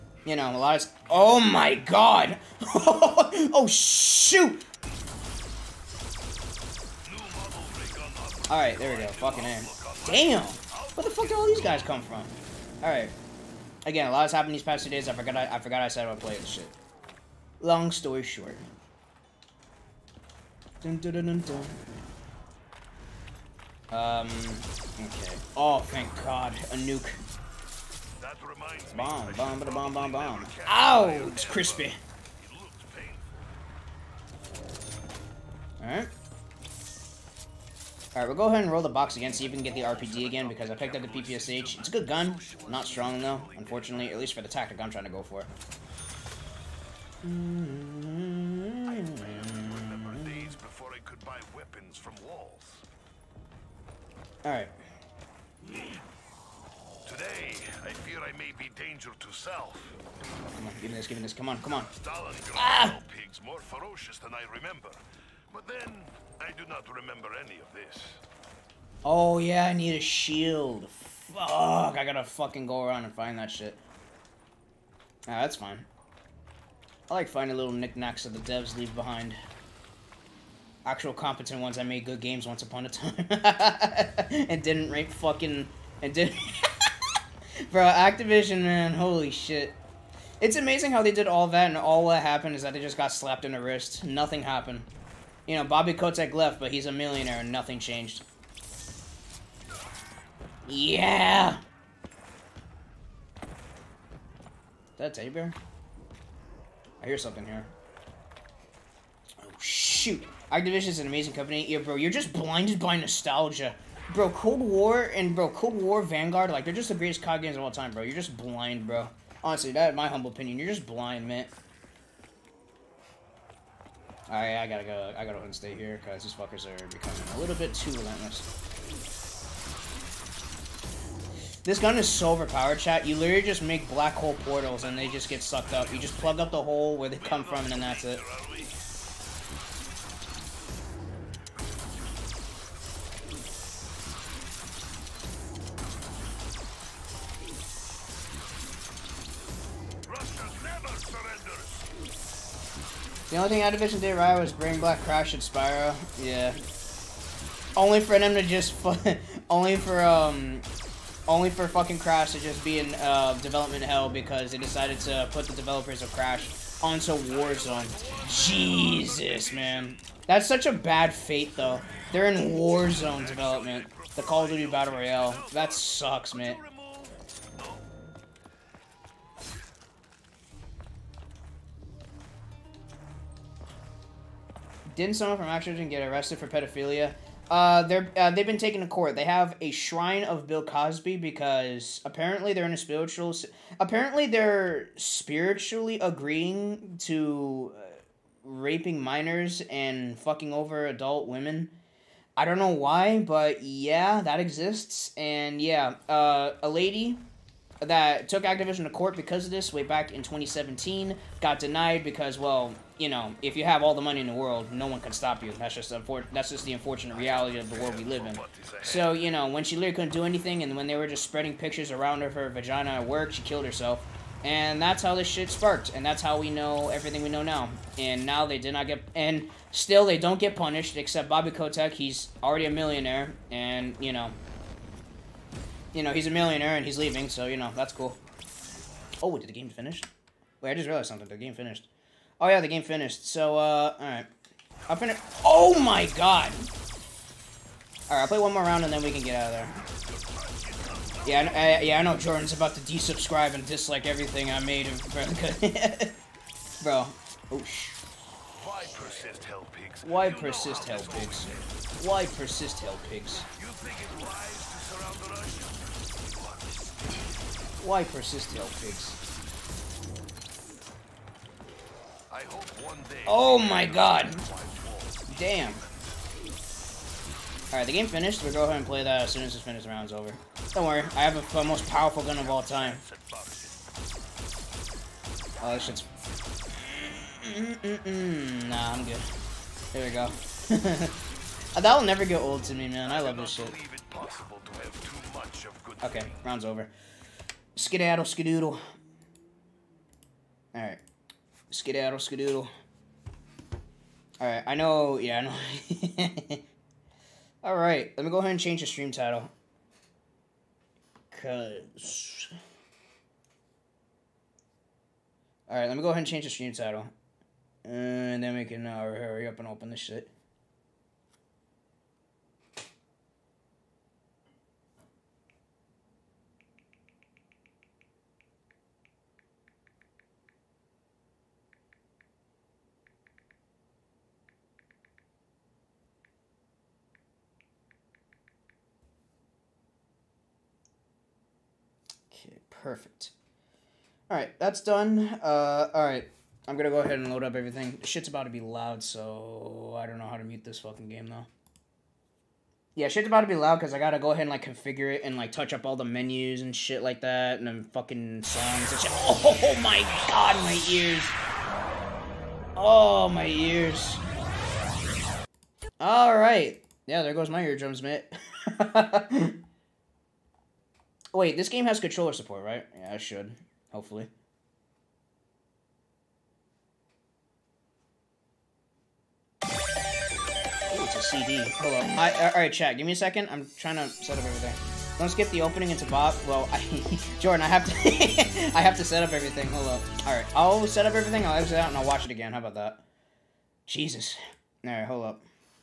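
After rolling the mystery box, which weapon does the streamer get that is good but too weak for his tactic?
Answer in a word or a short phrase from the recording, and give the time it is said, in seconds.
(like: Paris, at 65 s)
PPSH, at 41 s.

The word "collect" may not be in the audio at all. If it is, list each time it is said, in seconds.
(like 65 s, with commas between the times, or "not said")
not said.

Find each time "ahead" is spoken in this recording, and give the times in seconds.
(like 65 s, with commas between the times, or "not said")
38 s, 278 s, 308 s, 316 s, 347 s, 354 s.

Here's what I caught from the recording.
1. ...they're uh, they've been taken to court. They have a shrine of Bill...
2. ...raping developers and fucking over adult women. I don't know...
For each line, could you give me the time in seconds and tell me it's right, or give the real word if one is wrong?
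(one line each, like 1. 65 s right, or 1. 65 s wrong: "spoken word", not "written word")
1. 187 s right
2. 198 s wrong: "minors", not "developers".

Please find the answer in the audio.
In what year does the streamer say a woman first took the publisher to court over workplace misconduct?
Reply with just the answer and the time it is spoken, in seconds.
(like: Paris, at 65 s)
2017, at 210 s.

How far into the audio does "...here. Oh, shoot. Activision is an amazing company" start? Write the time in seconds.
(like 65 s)
107 s.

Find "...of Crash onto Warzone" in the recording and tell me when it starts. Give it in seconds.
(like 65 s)
166 s.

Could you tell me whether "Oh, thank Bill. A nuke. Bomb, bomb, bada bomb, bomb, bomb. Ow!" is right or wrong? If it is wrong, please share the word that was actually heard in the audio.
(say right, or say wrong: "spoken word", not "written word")
wrong: "God", not "Bill".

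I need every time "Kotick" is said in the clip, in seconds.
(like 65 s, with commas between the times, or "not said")
95 s, 231 s.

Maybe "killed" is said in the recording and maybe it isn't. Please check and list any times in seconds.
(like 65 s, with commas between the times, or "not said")
223 s.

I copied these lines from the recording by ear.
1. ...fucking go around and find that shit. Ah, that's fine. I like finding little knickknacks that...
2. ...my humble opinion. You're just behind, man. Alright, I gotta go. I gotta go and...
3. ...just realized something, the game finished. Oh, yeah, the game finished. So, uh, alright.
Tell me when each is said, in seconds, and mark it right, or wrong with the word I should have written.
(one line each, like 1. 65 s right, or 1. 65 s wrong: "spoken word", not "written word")
1. 72 s right
2. 119 s wrong: "blind", not "behind"
3. 240 s right.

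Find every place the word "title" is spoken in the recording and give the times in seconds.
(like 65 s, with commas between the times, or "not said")
309 s, 316 s.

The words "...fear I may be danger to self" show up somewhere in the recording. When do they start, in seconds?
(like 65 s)
58 s.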